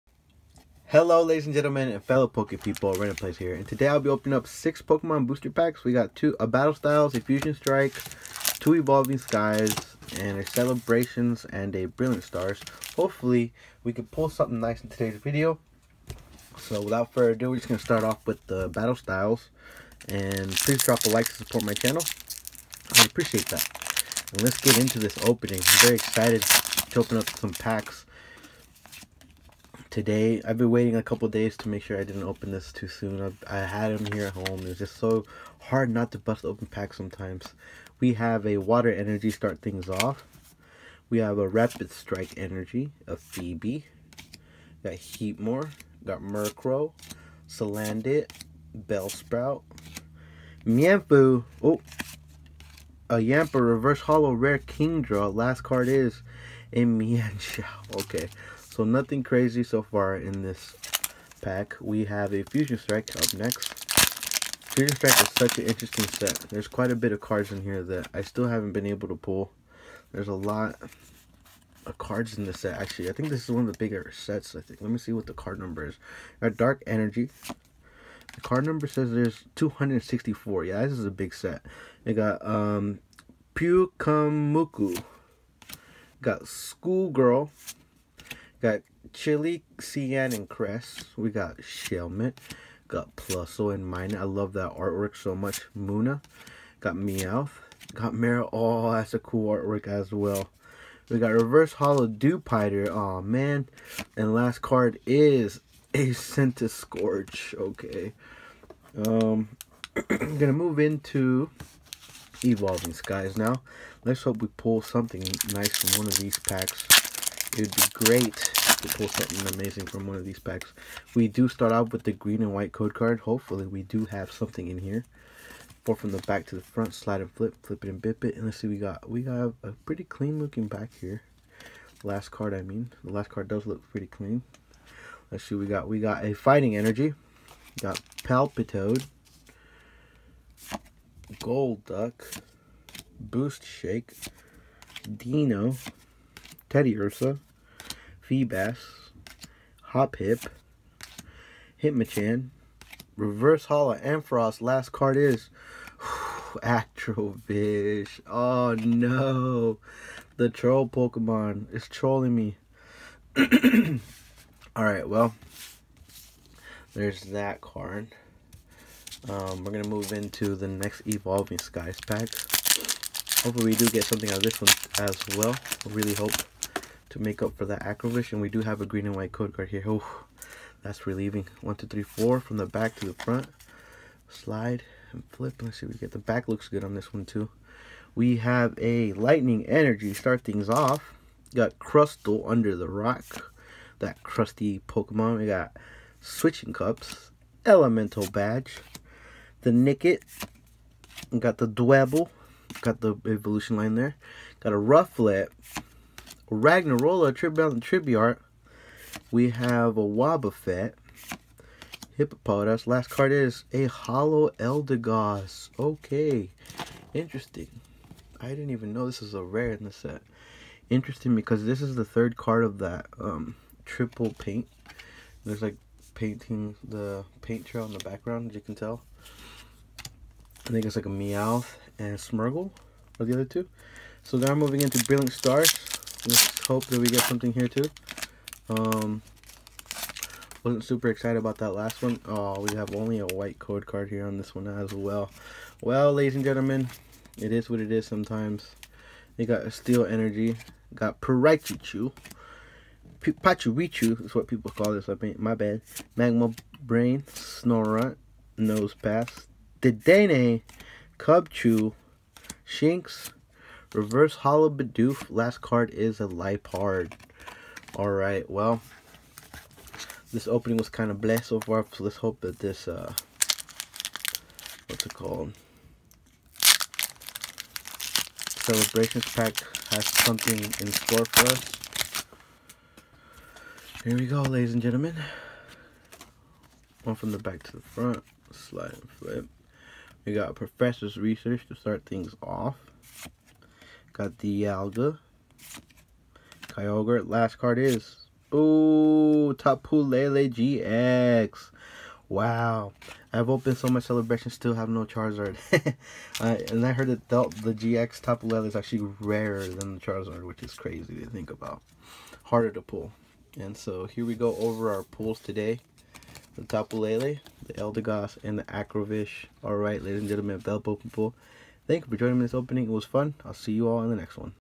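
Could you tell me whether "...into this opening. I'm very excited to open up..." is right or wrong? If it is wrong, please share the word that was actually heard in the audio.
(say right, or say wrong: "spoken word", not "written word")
right.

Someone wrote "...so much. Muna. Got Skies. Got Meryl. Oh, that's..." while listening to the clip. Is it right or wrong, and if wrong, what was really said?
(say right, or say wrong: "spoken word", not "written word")
wrong: "Meowth", not "Skies".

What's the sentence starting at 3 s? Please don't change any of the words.
And today I'll be opening up six Pokemon booster packs.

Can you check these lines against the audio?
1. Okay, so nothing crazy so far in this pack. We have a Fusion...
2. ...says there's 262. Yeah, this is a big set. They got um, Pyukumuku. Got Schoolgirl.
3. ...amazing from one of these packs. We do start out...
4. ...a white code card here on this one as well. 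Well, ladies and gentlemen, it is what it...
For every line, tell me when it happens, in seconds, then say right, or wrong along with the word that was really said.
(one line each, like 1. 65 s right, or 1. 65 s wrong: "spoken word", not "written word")
1. 58 s right
2. 78 s wrong: "264", not "262"
3. 119 s right
4. 243 s right.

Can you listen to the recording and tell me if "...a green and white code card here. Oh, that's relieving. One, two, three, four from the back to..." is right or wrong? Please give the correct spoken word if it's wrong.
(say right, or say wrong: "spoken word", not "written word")
right.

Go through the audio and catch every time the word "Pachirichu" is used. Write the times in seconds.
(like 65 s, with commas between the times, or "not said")
253 s.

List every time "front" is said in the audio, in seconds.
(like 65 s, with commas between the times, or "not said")
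126 s, 183 s, 287 s.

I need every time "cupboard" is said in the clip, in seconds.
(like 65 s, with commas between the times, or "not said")
not said.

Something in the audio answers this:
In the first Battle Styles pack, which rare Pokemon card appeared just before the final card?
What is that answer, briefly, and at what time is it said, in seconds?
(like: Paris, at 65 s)
Kingdra, at 54 s.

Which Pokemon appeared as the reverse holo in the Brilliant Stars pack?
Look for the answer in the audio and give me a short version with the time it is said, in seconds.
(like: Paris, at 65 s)
Bidoof, at 263 s.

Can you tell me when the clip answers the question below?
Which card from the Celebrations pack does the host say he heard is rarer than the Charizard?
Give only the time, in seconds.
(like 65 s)
299 s.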